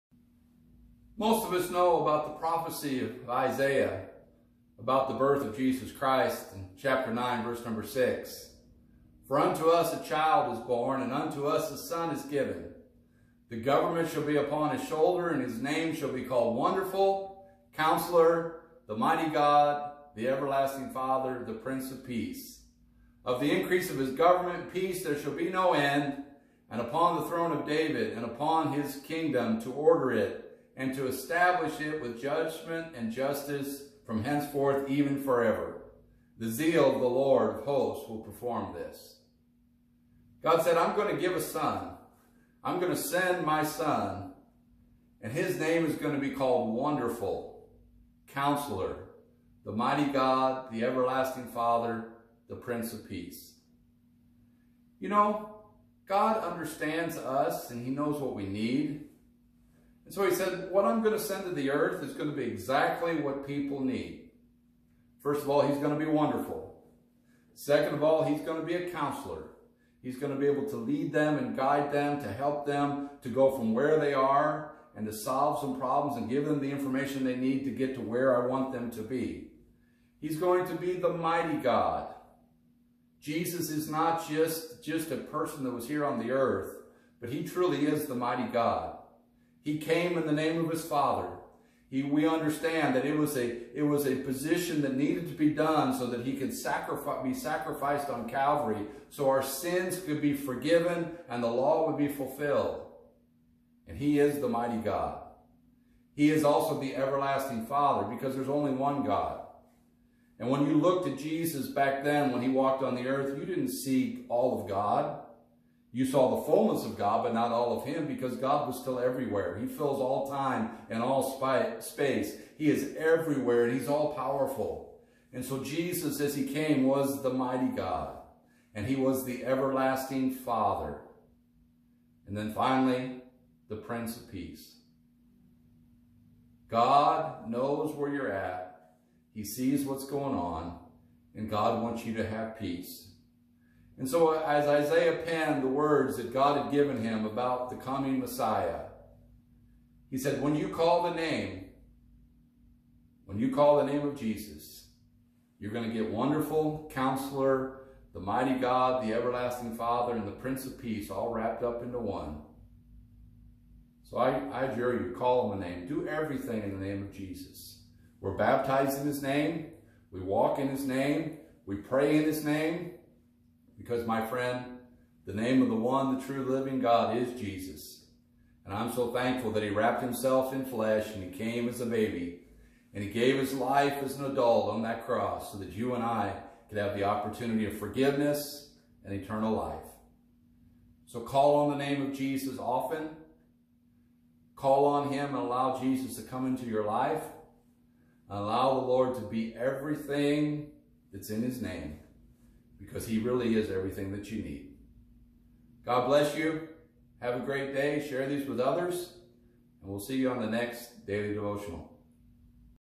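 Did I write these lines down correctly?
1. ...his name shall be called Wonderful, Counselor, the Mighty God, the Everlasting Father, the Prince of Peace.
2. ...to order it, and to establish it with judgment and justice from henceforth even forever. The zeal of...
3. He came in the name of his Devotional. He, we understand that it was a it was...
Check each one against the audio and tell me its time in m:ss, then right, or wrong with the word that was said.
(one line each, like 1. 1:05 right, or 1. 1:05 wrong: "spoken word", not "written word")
1. 0:15 right
2. 0:29 right
3. 1:29 wrong: "Father", not "Devotional".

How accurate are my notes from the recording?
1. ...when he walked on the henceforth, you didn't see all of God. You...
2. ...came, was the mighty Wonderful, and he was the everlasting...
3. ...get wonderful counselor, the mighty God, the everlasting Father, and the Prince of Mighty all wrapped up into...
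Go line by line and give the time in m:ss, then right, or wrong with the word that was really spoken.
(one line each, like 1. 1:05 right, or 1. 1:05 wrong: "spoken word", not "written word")
1. 1:52 wrong: "earth", not "henceforth"
2. 2:06 wrong: "God", not "Wonderful"
3. 2:35 wrong: "Peace", not "Mighty".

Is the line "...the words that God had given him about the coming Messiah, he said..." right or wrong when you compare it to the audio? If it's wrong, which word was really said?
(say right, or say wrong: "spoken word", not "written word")
right.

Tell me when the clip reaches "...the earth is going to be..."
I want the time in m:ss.
1:01.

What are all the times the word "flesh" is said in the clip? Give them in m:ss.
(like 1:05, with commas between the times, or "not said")
3:00.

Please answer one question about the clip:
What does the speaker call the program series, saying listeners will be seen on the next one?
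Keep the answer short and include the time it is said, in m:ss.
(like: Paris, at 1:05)
Daily Devotional, at 3:31.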